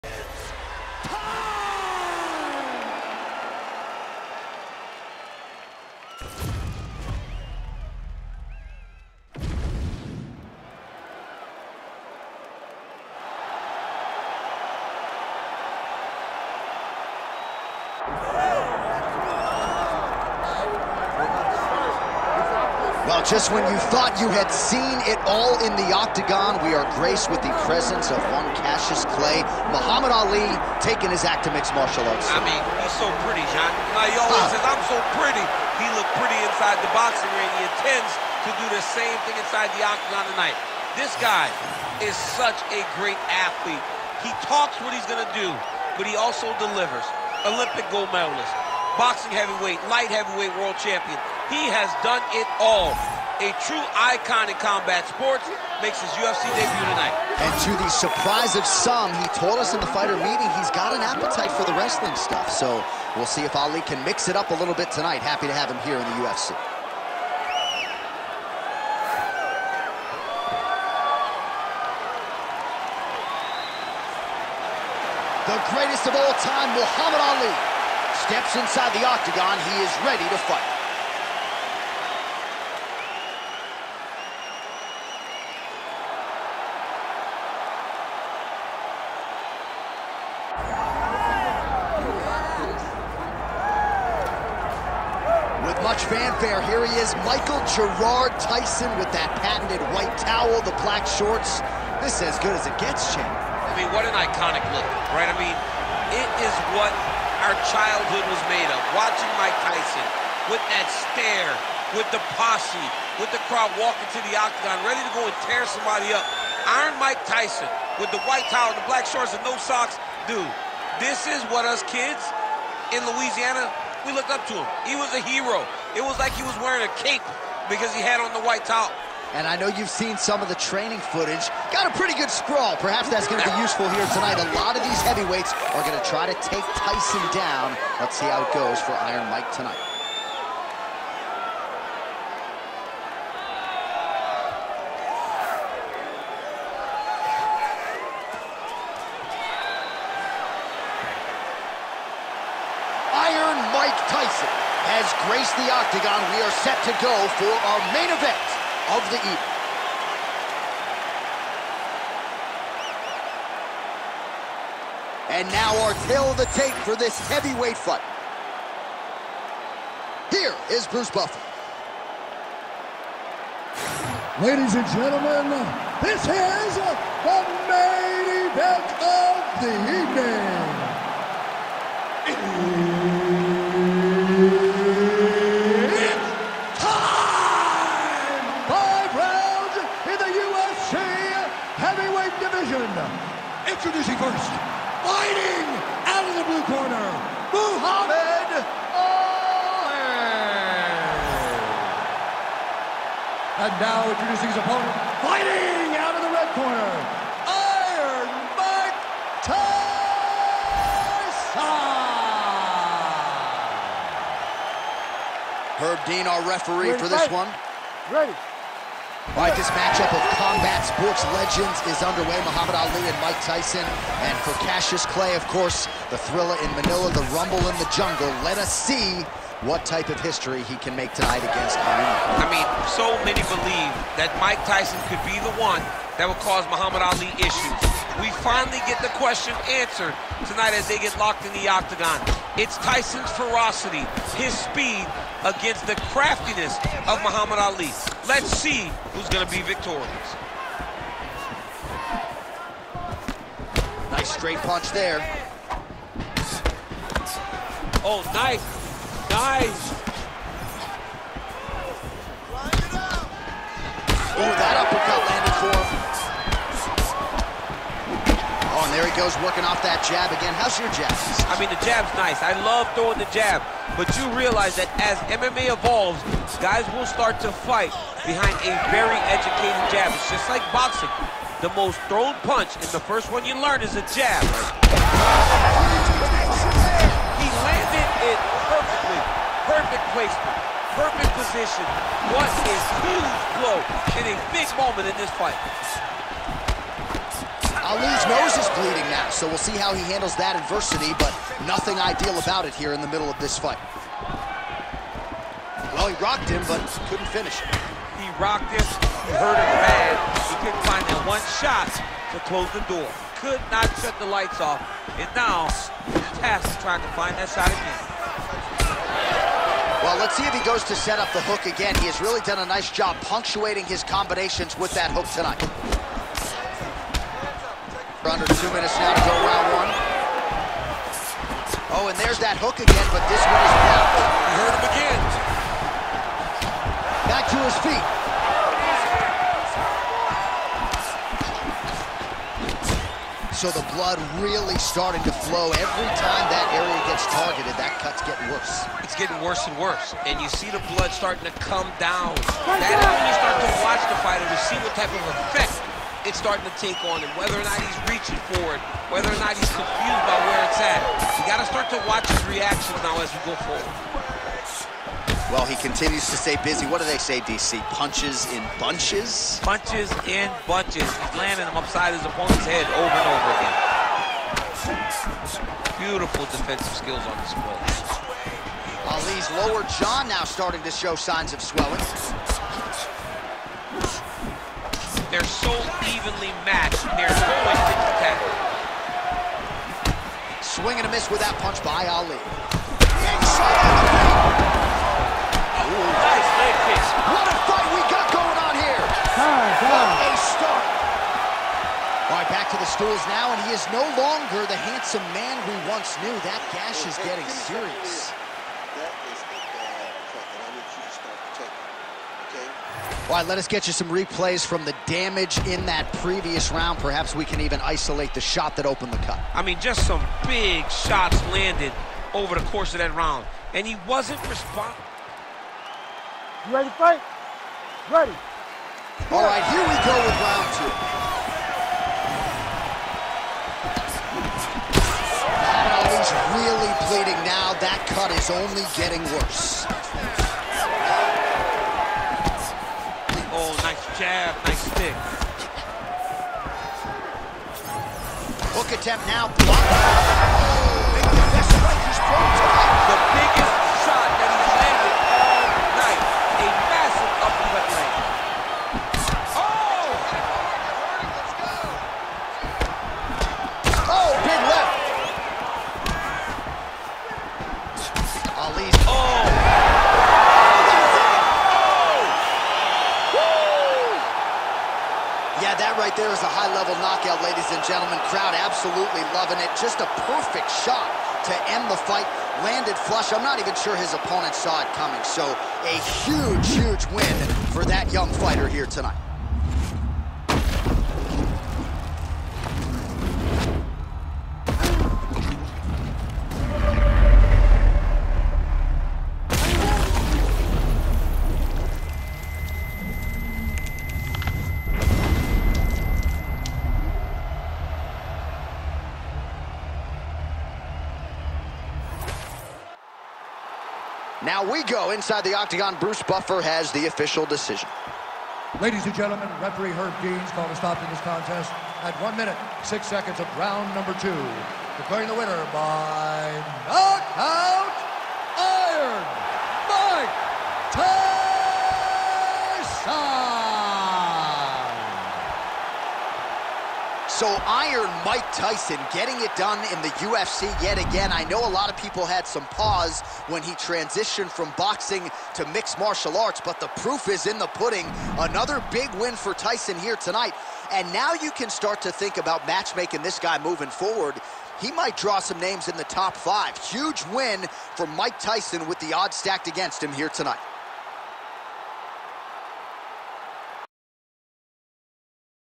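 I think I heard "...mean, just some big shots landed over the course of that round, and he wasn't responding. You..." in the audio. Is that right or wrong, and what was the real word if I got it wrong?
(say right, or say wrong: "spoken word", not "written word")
right.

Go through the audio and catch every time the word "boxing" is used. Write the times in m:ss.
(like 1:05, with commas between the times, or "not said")
0:36, 0:48, 4:40, 9:04.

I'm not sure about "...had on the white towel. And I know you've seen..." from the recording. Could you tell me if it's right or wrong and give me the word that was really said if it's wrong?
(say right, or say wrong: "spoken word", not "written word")
right.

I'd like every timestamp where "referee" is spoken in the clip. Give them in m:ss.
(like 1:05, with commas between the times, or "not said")
3:36, 8:39.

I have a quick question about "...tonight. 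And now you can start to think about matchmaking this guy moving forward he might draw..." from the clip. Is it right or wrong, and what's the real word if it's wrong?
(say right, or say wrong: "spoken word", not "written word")
right.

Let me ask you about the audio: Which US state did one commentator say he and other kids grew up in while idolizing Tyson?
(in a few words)
Louisiana.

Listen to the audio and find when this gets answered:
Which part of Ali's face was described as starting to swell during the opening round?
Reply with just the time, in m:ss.
6:19.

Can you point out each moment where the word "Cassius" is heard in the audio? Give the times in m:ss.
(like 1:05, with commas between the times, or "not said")
0:28, 3:44.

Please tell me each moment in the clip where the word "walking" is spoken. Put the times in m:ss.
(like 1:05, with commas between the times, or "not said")
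1:53.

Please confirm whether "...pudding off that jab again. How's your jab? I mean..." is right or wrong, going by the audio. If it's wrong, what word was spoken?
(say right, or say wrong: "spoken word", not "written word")
wrong: "working", not "pudding".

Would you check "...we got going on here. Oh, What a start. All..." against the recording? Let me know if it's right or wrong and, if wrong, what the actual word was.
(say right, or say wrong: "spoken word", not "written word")
right.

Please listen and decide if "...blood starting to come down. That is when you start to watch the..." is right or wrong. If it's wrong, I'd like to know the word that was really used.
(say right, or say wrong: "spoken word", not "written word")
right.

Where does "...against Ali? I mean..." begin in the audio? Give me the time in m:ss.
3:51.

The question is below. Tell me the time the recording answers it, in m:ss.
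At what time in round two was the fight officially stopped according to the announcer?
8:42.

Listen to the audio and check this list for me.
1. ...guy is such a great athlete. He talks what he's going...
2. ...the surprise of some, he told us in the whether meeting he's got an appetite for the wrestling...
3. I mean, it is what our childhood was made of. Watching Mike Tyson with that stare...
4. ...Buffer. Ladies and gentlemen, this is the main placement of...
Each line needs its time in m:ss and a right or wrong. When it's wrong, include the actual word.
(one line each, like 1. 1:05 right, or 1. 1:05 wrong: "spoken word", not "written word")
1. 0:41 right
2. 0:57 wrong: "fighter", not "whether"
3. 1:45 right
4. 2:51 wrong: "event", not "placement".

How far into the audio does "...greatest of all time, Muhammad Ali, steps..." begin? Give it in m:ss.
1:15.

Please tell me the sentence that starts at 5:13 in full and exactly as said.
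Could not shut the lights off, and now Tass is trying to find that shot again.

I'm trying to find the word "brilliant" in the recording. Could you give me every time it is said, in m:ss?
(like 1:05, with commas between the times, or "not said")
not said.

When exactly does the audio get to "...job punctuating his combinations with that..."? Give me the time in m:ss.
5:22.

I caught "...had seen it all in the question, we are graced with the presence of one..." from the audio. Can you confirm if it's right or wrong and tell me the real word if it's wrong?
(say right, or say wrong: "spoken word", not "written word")
wrong: "octagon", not "question".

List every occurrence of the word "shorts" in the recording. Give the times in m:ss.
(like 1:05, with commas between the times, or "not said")
1:41, 1:59.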